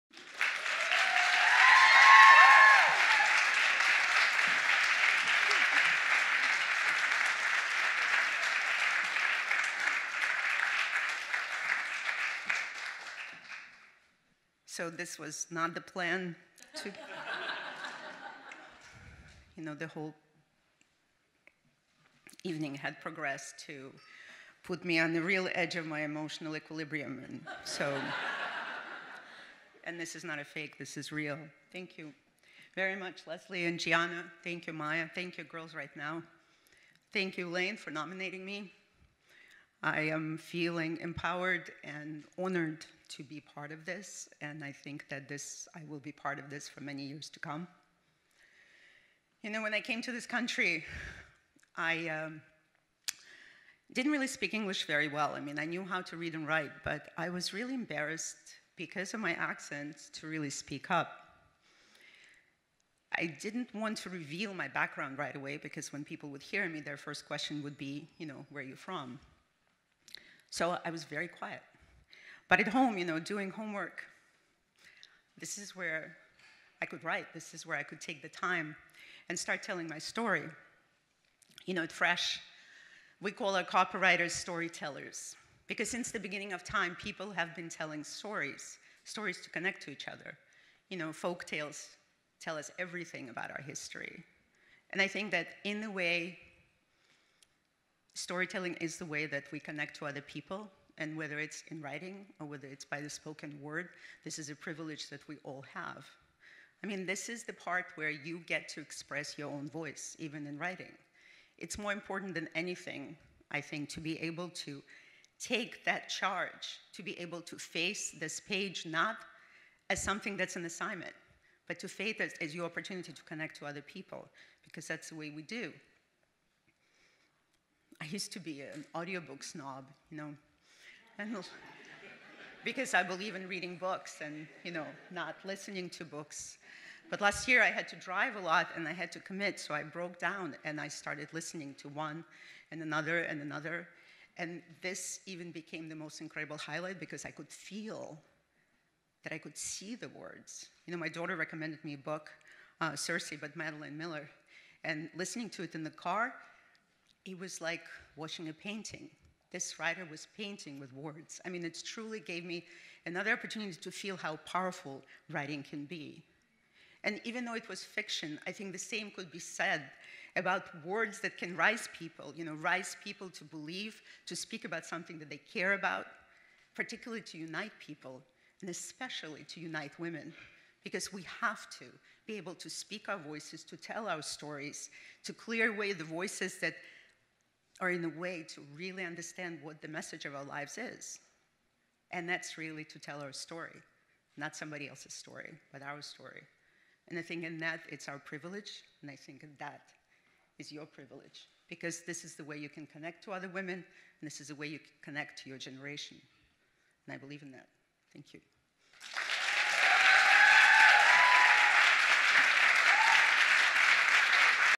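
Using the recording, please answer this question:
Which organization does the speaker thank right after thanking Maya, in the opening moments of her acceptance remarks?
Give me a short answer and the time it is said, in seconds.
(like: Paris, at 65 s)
Girls Write Now, at 35 s.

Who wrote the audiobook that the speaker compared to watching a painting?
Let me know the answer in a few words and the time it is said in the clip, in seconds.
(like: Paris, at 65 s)
Madeline Miller, at 153 s.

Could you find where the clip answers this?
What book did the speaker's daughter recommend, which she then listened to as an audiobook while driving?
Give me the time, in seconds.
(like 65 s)
152 s.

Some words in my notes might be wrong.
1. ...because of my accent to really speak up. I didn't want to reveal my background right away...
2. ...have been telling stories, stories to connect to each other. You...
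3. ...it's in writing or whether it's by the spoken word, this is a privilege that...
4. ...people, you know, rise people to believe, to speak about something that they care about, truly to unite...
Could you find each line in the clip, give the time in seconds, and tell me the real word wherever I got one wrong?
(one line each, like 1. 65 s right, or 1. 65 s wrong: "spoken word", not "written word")
1. 58 s right
2. 87 s right
3. 101 s right
4. 171 s wrong: "particularly", not "truly".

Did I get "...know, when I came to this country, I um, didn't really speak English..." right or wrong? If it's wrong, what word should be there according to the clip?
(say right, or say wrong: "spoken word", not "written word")
right.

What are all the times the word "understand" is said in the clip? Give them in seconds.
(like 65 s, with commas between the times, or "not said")
189 s.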